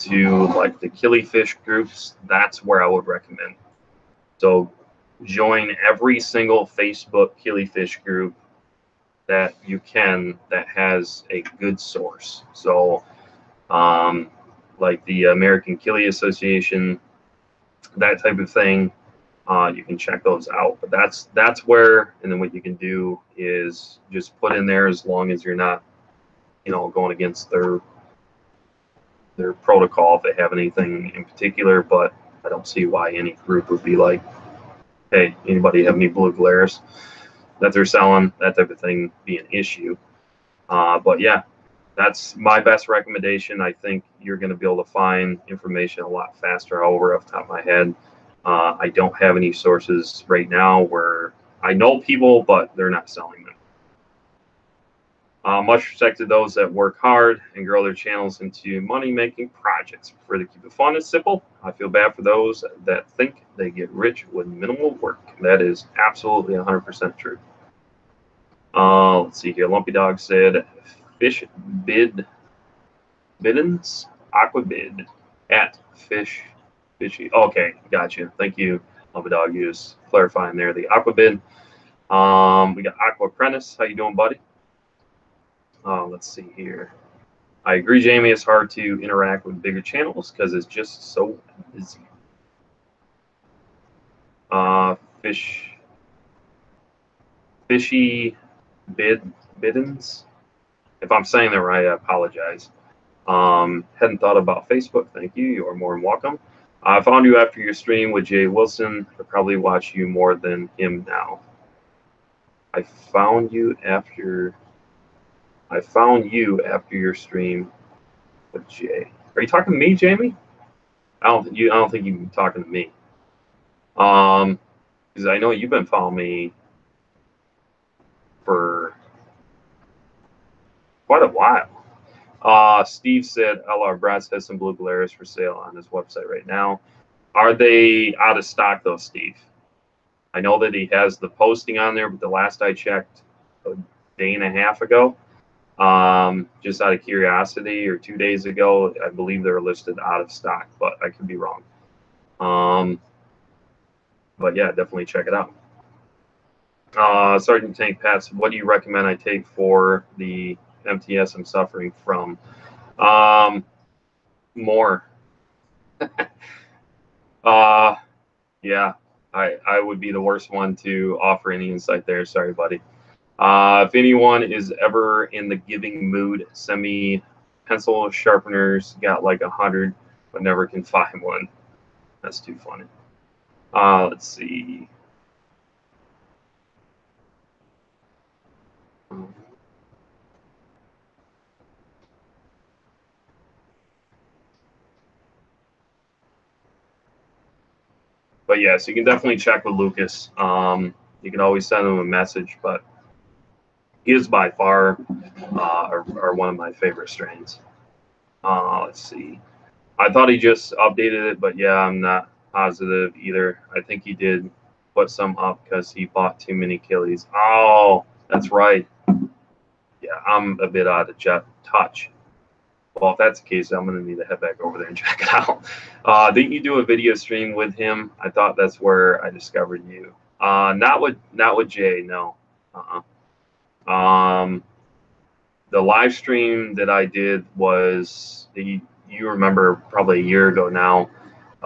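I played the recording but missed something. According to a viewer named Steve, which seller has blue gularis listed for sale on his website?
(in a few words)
LR Brass.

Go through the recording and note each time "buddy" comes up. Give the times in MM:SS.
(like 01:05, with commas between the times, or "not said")
01:24, 02:52.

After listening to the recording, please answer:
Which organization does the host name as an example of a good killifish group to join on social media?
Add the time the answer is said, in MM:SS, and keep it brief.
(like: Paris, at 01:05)
American Killie Association, at 00:15.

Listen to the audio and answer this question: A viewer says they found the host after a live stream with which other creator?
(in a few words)
Jay Wilson.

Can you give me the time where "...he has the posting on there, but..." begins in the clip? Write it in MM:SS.
02:20.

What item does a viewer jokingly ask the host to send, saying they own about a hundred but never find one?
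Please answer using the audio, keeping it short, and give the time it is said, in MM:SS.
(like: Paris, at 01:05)
Pencil sharpeners, at 02:57.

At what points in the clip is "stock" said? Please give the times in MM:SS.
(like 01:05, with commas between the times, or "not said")
02:18, 02:30.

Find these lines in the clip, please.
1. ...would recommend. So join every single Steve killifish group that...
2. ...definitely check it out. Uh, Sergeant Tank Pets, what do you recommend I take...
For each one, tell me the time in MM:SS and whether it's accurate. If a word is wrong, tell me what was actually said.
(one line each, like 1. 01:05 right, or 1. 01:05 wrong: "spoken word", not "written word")
1. 00:02 wrong: "Facebook", not "Steve"
2. 02:34 right.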